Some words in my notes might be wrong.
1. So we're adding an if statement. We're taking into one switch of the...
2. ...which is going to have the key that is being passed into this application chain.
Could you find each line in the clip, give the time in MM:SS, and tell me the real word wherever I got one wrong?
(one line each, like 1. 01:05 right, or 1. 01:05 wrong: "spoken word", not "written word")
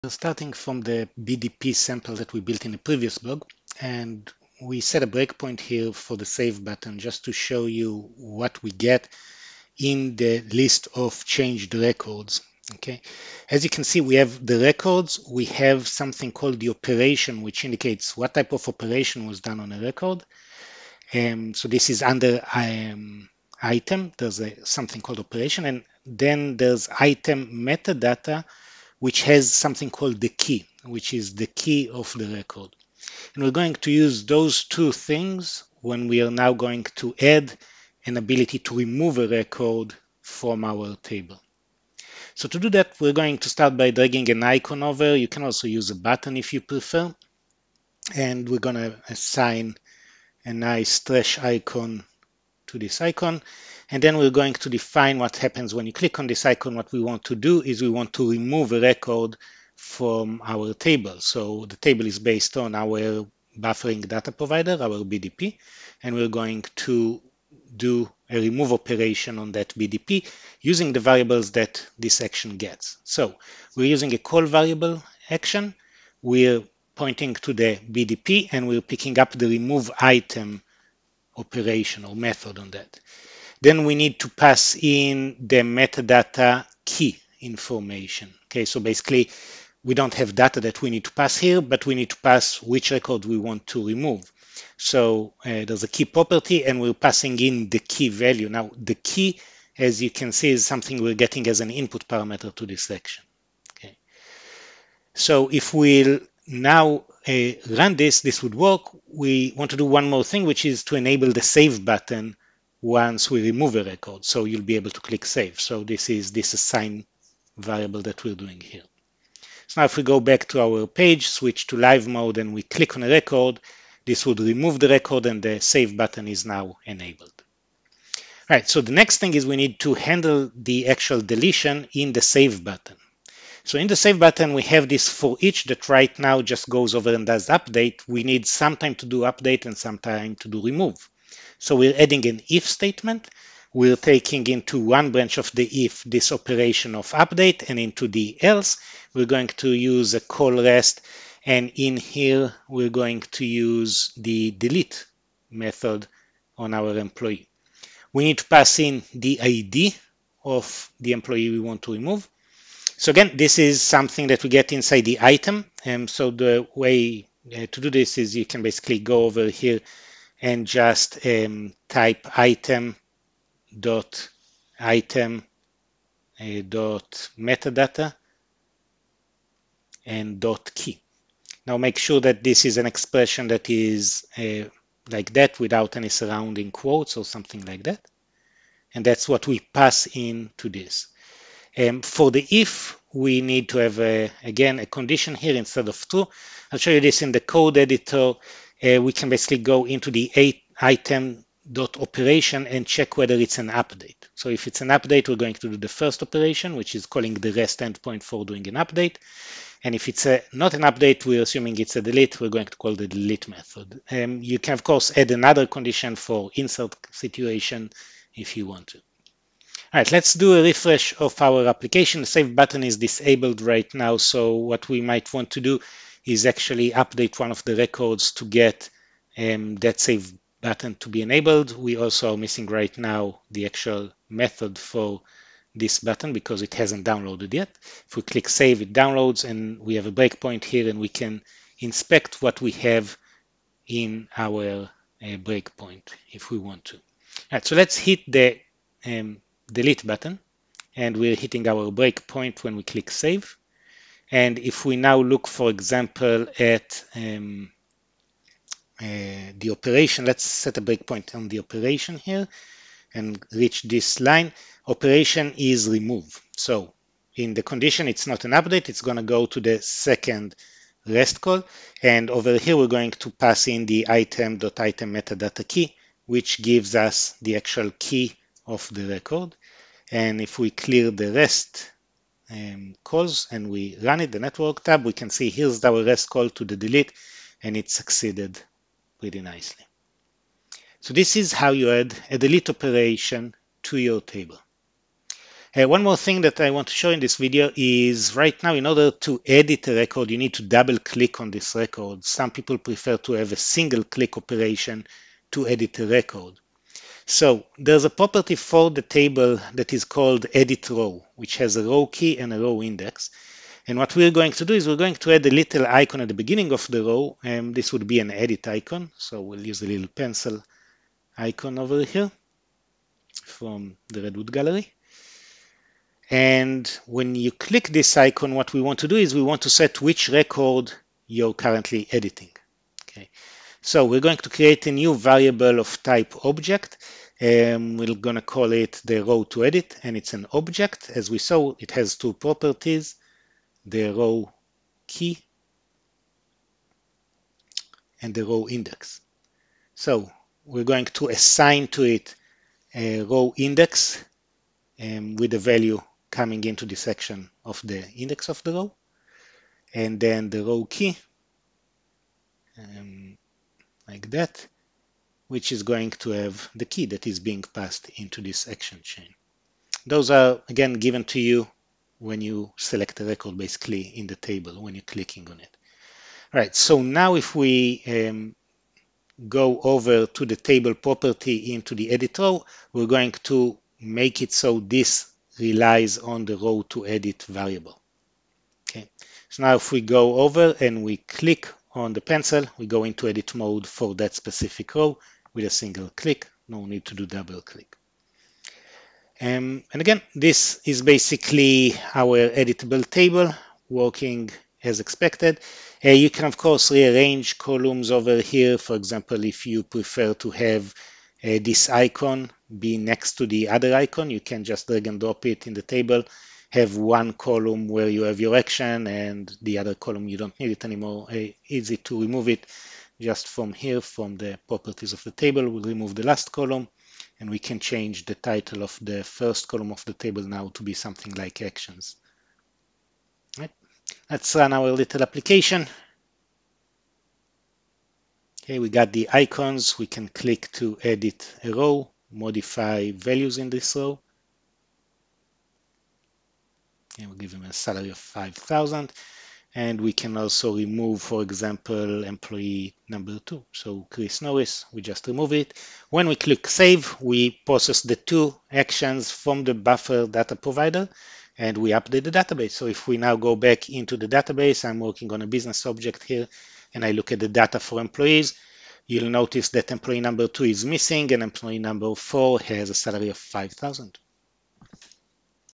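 1. 02:21 wrong: "branch", not "switch"
2. 06:05 wrong: "action", not "application".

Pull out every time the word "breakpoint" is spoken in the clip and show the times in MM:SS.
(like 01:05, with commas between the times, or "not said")
00:05, 04:00, 04:05, 04:11, 04:20.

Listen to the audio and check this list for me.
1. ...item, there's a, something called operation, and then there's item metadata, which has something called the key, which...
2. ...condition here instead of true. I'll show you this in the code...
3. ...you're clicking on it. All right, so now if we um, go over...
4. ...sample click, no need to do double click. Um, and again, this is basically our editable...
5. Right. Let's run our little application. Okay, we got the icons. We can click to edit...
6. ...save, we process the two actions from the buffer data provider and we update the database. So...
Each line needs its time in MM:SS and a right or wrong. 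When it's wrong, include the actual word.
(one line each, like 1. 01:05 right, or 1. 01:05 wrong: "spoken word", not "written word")
1. 00:23 right
2. 03:14 right
3. 06:14 right
4. 06:35 wrong: "single", not "sample"
5. 07:13 right
6. 07:36 right.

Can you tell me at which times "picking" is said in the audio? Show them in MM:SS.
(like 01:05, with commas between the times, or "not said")
01:18.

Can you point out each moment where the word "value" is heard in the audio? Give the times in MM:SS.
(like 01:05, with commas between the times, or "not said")
01:38, 05:55, 07:23.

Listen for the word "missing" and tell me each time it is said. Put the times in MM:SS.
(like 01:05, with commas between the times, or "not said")
03:52, 07:50.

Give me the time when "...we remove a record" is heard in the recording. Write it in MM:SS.
01:53.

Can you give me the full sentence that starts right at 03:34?
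Um, you can, of course, add another condition for insert situation if you want to.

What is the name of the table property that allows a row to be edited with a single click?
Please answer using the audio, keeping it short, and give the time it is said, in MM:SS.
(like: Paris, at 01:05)
Edit row, at 05:10.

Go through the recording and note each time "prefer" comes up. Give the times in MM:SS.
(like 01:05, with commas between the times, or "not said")
00:46, 05:02, 06:49.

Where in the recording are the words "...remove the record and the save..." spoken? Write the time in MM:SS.
02:04.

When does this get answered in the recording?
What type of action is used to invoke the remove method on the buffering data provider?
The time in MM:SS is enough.
01:14.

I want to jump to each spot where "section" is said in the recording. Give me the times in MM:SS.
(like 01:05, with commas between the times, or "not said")
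01:42, 05:56.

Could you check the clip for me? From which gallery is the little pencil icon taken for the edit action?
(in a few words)
Redwood Gallery.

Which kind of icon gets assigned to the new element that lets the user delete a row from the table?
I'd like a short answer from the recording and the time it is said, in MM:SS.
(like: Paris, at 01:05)
Trash icon, at 00:50.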